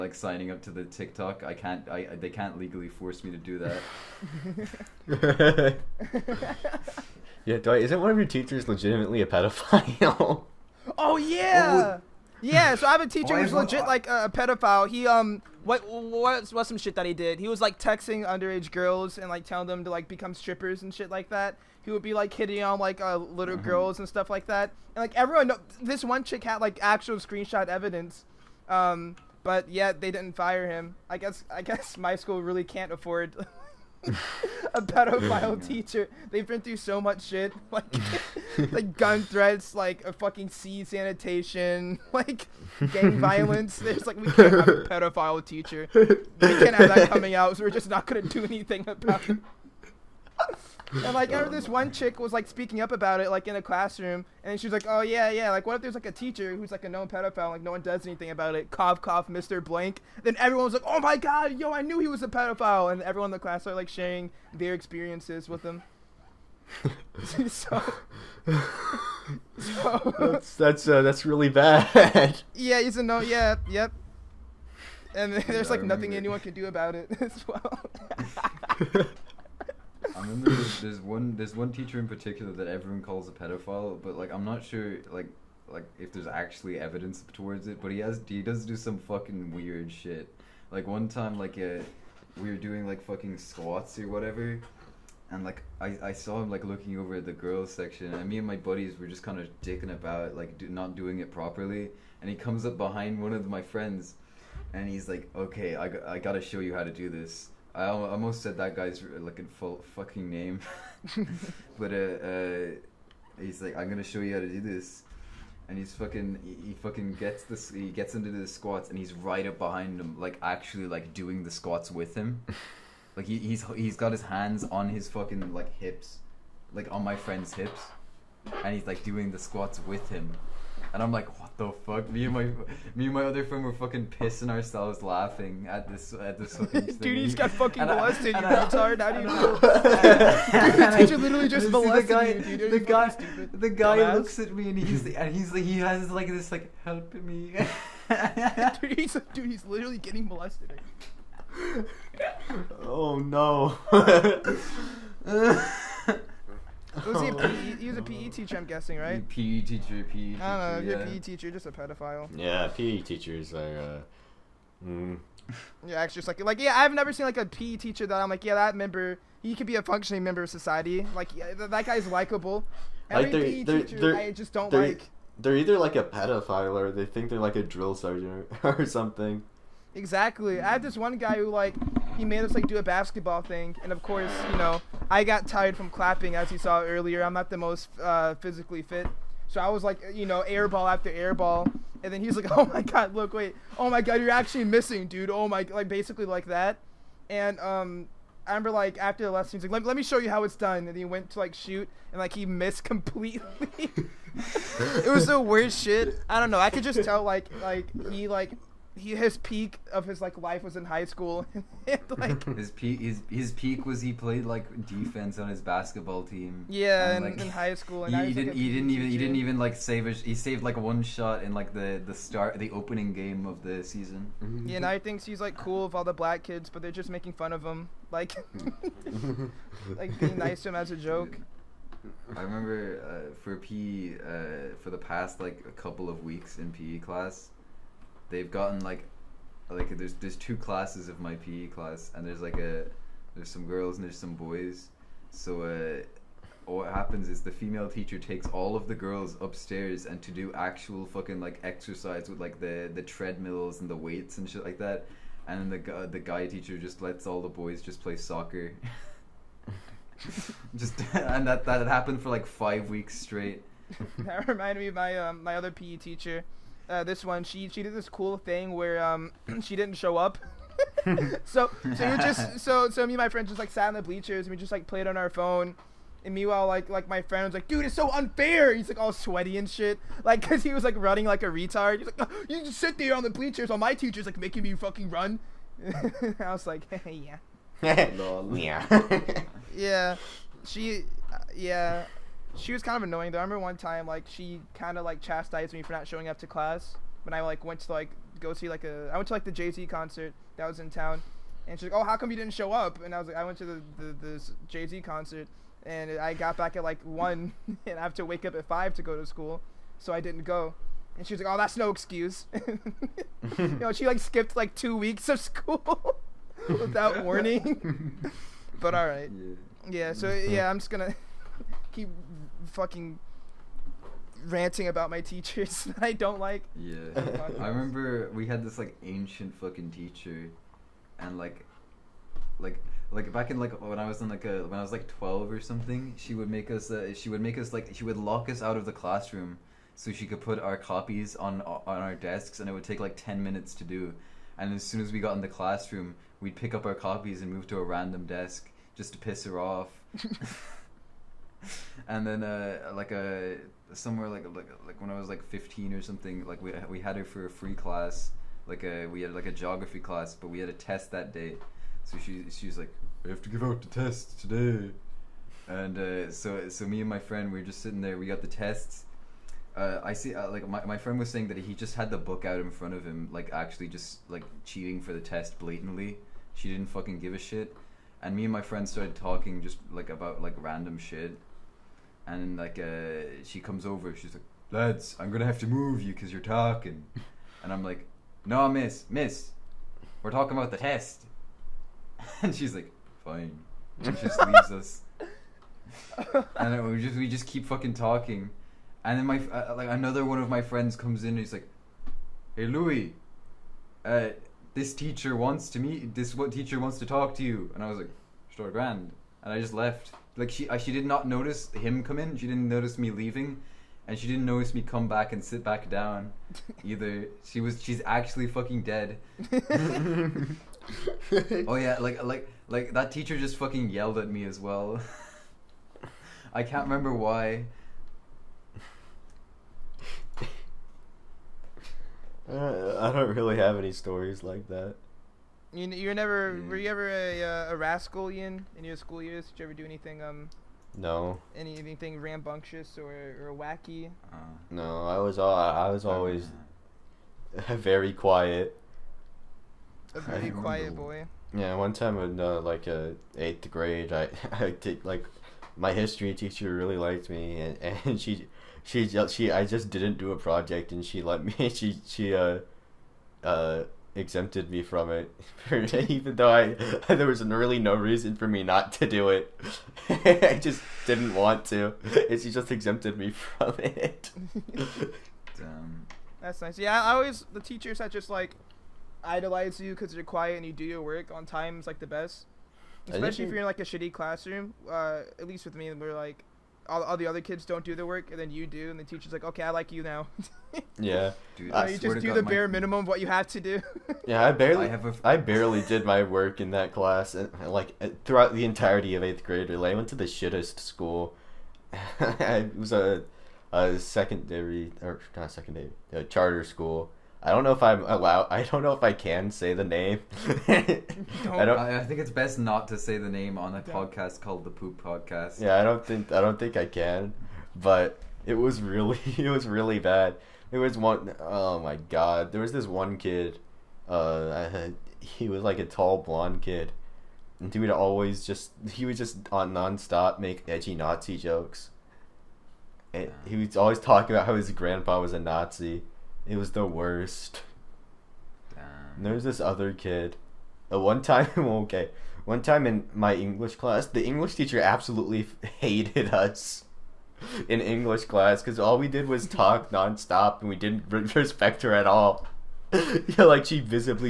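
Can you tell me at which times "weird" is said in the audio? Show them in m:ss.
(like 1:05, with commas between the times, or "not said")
1:29.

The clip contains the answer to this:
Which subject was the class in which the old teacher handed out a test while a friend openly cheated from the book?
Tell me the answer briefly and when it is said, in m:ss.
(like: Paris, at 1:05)
Geography, at 5:59.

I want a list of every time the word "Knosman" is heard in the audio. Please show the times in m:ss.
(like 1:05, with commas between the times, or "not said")
not said.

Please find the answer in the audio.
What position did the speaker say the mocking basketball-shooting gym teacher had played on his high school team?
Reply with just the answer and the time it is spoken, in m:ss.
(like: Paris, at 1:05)
Defense, at 3:34.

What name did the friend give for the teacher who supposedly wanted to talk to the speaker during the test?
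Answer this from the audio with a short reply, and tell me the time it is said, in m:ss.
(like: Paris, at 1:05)
Louis, at 6:42.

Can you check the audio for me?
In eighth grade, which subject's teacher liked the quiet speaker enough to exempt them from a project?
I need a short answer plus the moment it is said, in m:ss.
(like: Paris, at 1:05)
History, at 7:35.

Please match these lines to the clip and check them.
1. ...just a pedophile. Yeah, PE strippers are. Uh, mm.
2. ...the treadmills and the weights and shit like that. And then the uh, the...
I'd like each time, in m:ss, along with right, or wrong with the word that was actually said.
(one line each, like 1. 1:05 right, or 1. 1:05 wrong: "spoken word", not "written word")
1. 2:41 wrong: "teachers", not "strippers"
2. 4:12 right.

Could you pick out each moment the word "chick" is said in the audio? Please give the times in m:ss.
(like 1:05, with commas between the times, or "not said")
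0:26, 0:51.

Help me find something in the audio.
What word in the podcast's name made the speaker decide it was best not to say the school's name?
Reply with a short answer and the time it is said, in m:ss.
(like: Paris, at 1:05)
Poop, at 8:34.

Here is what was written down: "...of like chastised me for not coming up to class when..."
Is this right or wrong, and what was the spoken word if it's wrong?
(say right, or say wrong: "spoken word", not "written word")
wrong: "showing", not "coming".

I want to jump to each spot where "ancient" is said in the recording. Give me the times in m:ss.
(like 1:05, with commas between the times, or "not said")
5:29.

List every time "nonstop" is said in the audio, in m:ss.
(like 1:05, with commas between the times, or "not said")
8:49, 9:09.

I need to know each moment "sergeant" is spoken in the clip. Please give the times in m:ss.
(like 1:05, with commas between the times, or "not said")
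2:57.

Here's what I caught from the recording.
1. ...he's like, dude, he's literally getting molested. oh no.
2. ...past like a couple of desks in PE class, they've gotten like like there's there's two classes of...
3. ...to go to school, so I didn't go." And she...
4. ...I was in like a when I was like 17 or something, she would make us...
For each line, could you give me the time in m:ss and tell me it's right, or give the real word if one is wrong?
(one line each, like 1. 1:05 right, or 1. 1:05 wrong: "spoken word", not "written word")
1. 2:28 right
2. 3:54 wrong: "weeks", not "desks"
3. 5:08 right
4. 5:33 wrong: "12", not "17".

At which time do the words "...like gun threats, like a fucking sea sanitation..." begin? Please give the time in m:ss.
0:38.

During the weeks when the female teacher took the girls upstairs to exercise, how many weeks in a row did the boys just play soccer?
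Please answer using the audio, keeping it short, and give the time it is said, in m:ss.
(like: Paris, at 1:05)
5 weeks, at 4:22.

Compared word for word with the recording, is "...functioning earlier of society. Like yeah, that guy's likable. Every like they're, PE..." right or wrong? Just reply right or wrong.
wrong.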